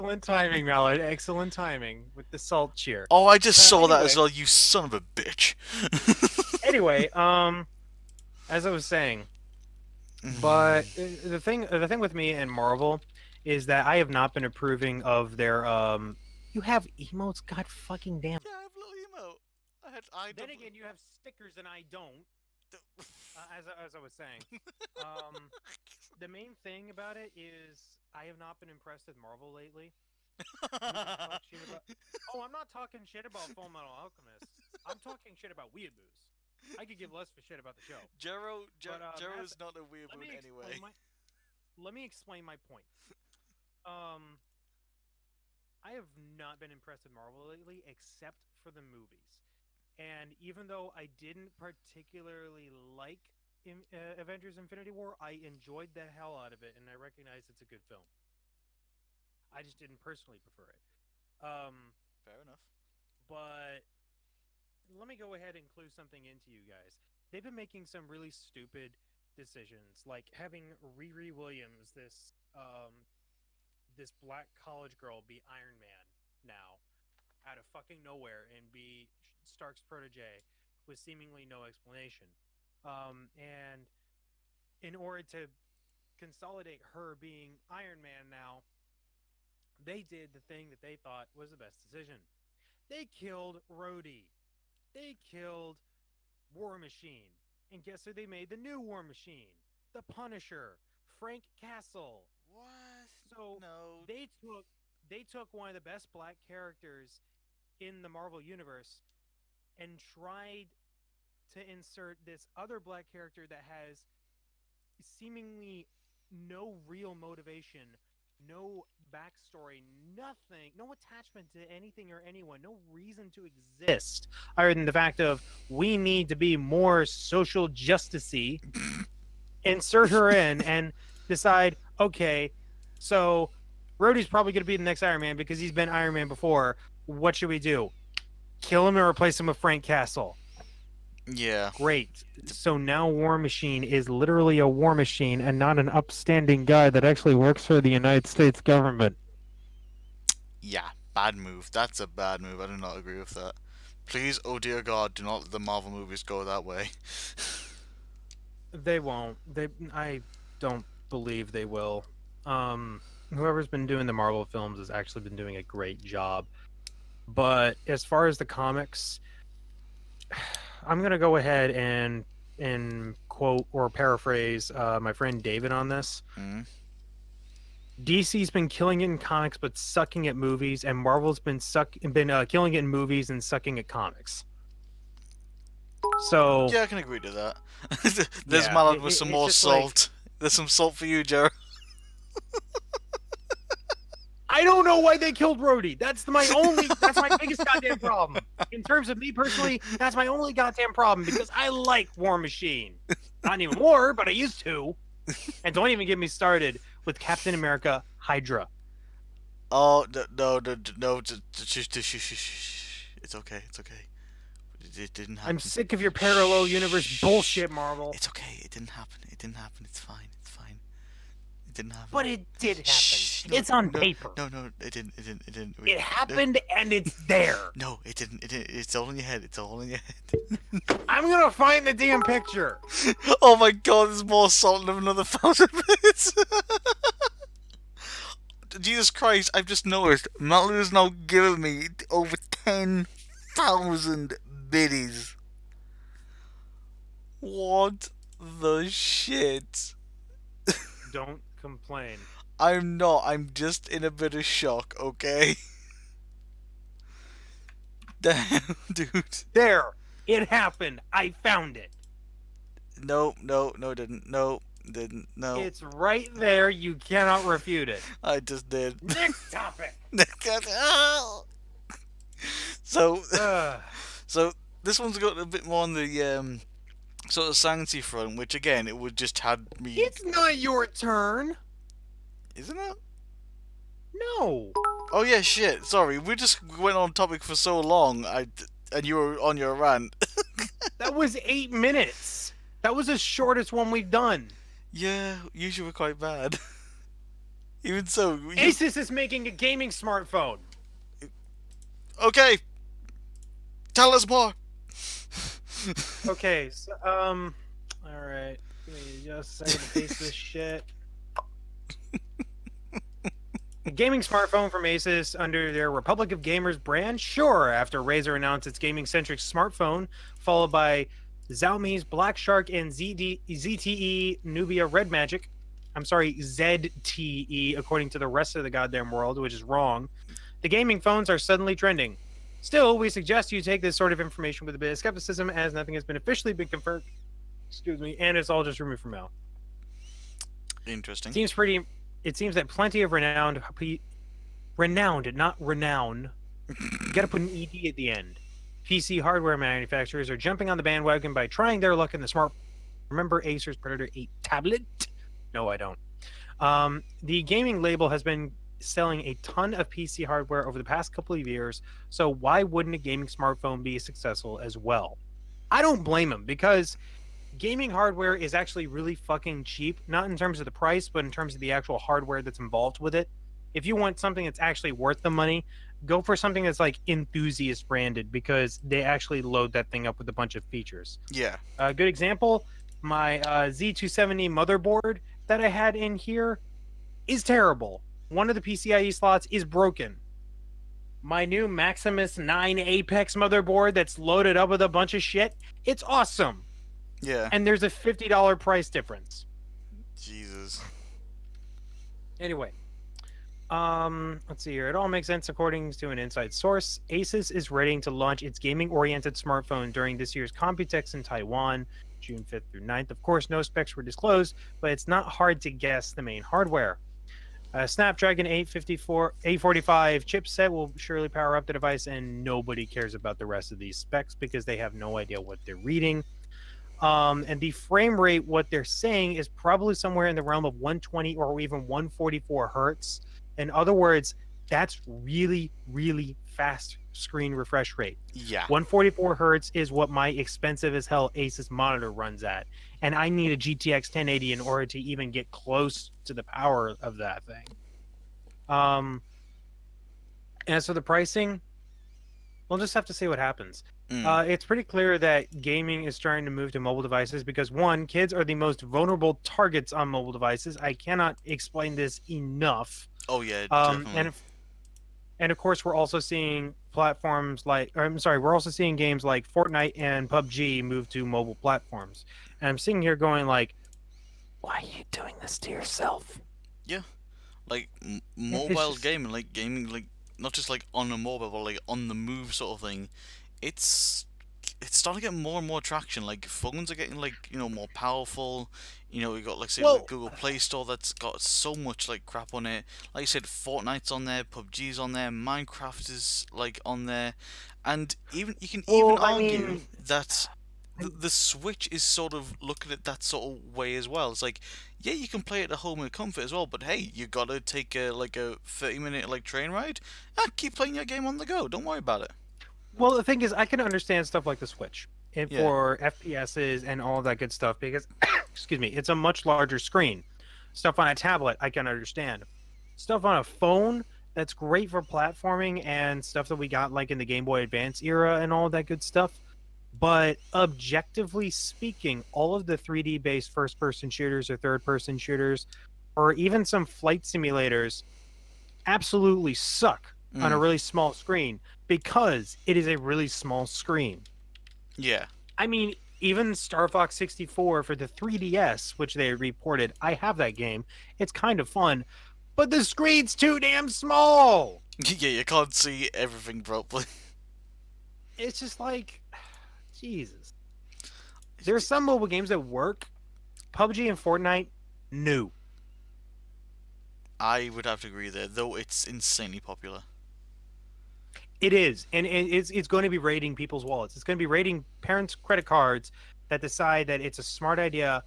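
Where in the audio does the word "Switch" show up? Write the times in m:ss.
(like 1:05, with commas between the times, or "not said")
8:21, 8:34.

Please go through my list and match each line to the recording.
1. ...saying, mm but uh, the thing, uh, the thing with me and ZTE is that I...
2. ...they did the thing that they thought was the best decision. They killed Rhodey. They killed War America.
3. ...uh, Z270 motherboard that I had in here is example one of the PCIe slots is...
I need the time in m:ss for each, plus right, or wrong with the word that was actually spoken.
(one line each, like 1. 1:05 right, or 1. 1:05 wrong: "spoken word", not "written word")
1. 0:08 wrong: "Marvel", not "ZTE"
2. 1:29 wrong: "Machine", not "America"
3. 6:23 wrong: "terrible", not "example".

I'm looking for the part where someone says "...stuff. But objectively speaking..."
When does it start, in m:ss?
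8:49.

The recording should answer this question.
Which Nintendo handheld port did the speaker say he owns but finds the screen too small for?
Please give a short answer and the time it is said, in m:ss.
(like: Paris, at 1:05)
Star Fox 64, at 9:06.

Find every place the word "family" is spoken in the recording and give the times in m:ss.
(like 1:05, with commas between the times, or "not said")
not said.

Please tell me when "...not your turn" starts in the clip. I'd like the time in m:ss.
4:40.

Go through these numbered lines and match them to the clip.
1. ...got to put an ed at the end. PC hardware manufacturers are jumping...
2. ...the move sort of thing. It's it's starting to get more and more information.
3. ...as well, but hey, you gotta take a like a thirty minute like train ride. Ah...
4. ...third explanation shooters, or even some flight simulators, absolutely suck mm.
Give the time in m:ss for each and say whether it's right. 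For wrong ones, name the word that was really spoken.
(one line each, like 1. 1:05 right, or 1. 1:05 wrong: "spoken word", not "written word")
1. 5:47 right
2. 8:02 wrong: "traction", not "information"
3. 8:26 right
4. 8:54 wrong: "person", not "explanation".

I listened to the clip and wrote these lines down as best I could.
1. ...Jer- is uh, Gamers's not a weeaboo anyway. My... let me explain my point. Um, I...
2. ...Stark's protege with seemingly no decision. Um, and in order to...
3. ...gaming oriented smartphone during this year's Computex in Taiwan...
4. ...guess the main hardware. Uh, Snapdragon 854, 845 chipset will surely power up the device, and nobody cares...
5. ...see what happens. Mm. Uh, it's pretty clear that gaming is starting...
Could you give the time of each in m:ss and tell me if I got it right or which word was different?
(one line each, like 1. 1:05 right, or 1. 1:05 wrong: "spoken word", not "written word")
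1. 0:38 wrong: "Jero", not "Gamers"
2. 1:19 wrong: "explanation", not "decision"
3. 6:48 right
4. 6:55 right
5. 7:33 right.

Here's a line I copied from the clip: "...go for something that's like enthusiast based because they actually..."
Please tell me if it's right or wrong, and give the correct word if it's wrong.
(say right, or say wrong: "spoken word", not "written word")
wrong: "branded", not "based".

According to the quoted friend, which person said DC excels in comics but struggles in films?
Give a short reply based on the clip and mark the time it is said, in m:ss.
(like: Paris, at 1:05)
David, at 2:55.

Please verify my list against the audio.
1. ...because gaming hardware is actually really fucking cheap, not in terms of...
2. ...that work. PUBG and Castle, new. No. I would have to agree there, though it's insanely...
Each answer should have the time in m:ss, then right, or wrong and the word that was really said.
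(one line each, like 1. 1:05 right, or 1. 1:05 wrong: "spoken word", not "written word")
1. 6:06 right
2. 9:22 wrong: "Fortnite", not "Castle".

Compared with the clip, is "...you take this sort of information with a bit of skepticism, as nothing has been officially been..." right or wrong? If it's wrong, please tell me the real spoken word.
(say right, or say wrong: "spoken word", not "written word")
right.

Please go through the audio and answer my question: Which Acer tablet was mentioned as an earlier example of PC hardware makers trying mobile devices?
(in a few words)
Predator 8.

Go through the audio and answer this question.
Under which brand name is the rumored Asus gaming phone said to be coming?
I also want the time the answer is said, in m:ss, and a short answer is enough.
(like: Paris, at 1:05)
Republic of Gamers, at 5:15.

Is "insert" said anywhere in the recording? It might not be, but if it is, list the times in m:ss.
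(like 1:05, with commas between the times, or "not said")
1:51, 2:09.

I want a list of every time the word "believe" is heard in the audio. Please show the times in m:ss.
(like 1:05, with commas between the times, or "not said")
2:41.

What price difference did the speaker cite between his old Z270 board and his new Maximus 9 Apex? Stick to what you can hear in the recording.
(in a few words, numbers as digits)
$50.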